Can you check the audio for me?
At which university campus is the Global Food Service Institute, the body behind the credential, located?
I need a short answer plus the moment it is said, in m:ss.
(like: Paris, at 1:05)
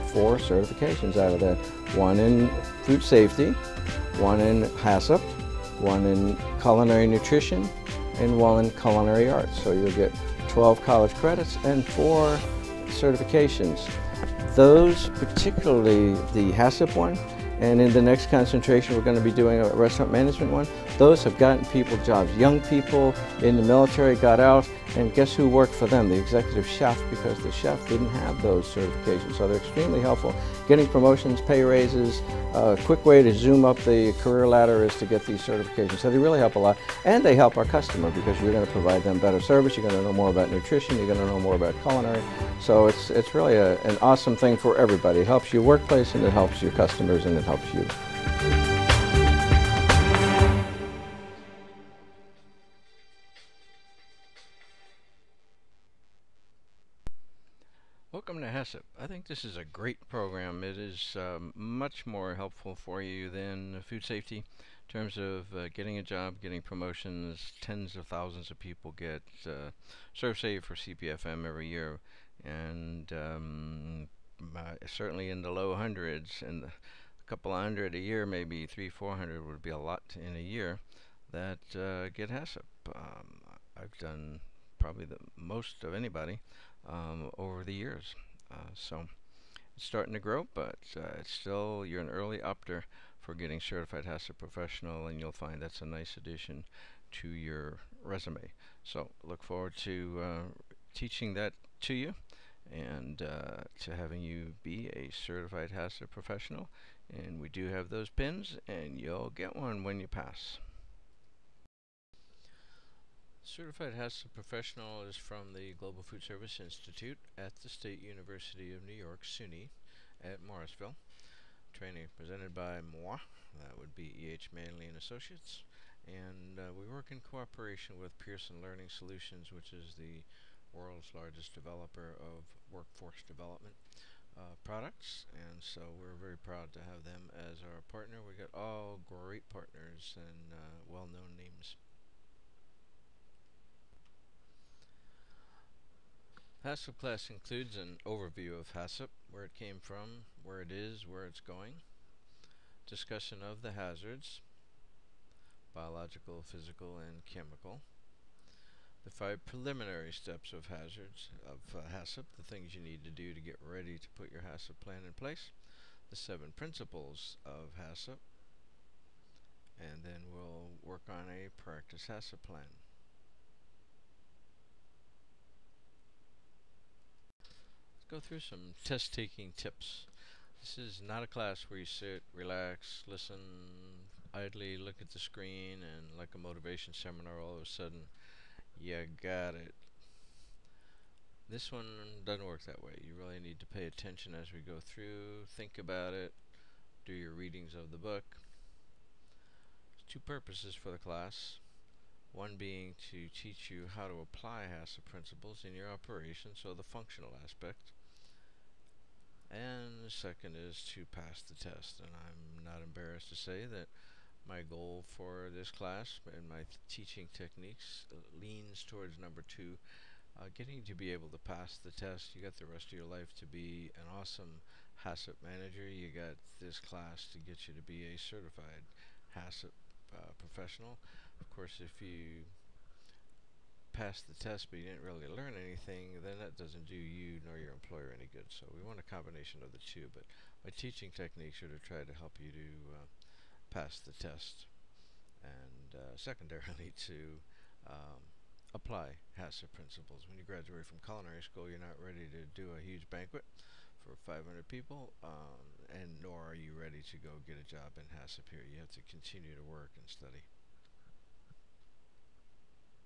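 Morrisville, at 2:00.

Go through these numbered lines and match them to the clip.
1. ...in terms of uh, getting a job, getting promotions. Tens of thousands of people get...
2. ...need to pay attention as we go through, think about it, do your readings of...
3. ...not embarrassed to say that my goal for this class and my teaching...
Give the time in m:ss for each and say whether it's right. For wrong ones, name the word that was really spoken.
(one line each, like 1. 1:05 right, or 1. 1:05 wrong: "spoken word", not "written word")
1. 1:04 right
2. 3:13 right
3. 3:32 right.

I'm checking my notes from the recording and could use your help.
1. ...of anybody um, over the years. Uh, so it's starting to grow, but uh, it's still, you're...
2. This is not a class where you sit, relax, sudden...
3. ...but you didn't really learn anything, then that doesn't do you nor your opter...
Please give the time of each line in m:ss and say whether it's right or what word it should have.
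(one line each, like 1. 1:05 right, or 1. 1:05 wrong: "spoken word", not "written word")
1. 1:25 right
2. 3:00 wrong: "listen", not "sudden"
3. 3:54 wrong: "employer", not "opter".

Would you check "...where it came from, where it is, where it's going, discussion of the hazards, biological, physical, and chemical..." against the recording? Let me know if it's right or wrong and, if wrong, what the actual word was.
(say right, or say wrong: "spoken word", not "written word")
right.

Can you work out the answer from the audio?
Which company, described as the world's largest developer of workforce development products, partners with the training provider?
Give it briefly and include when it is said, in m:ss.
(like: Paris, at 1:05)
Pearson Learning Solutions, at 2:08.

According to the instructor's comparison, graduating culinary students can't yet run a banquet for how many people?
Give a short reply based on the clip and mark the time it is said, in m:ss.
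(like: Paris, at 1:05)
500, at 4:14.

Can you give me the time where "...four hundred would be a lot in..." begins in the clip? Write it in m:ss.
1:18.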